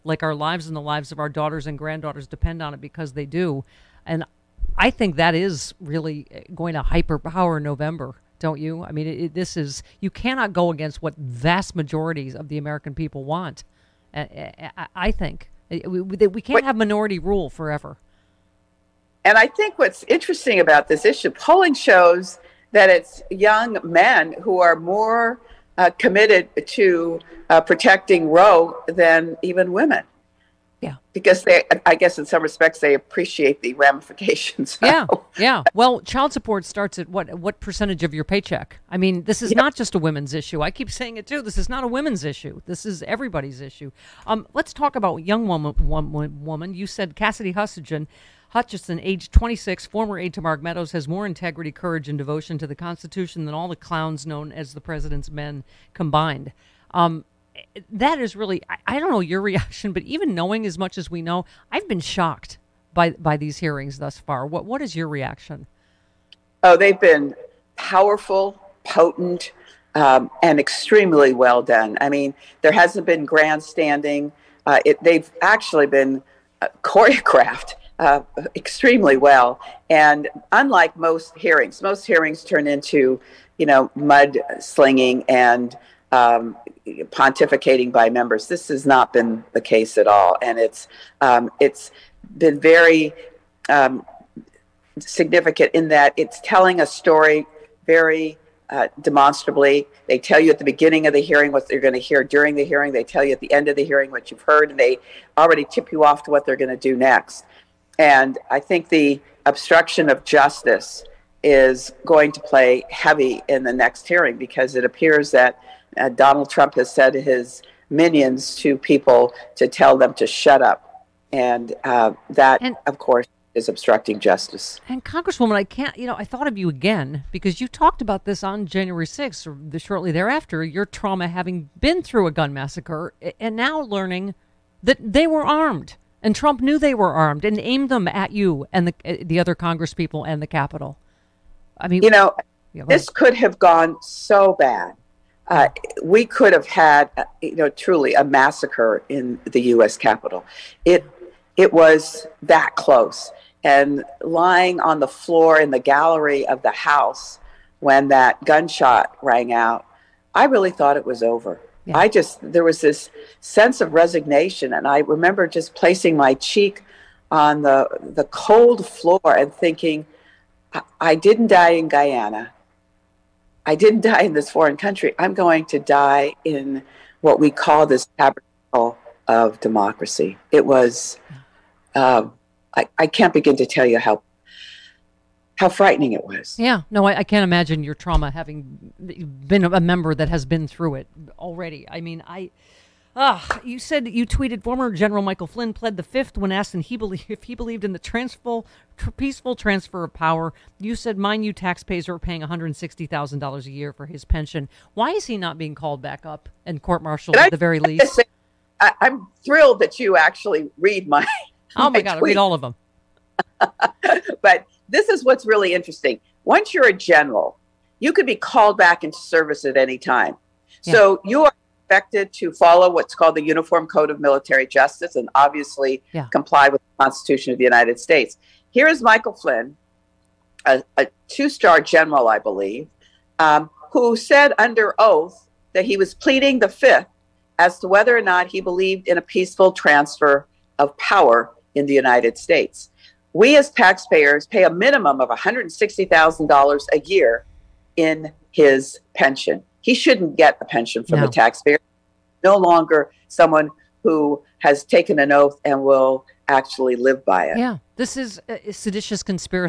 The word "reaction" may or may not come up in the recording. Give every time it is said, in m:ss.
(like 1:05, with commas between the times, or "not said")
0:59, 1:05.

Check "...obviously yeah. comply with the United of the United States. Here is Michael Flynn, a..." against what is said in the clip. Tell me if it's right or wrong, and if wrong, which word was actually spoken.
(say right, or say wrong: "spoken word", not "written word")
wrong: "Constitution", not "United".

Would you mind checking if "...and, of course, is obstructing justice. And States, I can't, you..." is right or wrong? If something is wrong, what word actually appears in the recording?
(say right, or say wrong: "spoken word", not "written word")
wrong: "Congresswoman", not "States".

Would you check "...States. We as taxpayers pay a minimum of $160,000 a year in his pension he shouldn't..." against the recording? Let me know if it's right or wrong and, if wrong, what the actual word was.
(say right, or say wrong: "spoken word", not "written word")
right.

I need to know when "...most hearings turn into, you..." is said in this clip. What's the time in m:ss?
1:21.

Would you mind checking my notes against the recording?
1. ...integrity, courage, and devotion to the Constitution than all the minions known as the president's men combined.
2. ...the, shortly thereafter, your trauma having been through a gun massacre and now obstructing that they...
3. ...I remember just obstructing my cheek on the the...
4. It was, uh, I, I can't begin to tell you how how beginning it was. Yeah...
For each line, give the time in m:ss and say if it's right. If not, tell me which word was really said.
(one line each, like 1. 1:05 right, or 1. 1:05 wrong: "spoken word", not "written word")
1. 0:51 wrong: "clowns", not "minions"
2. 2:09 wrong: "learning", not "obstructing"
3. 2:44 wrong: "placing", not "obstructing"
4. 3:00 wrong: "frightening", not "beginning".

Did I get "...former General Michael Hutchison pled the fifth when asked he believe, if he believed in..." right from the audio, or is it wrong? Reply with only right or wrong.
wrong.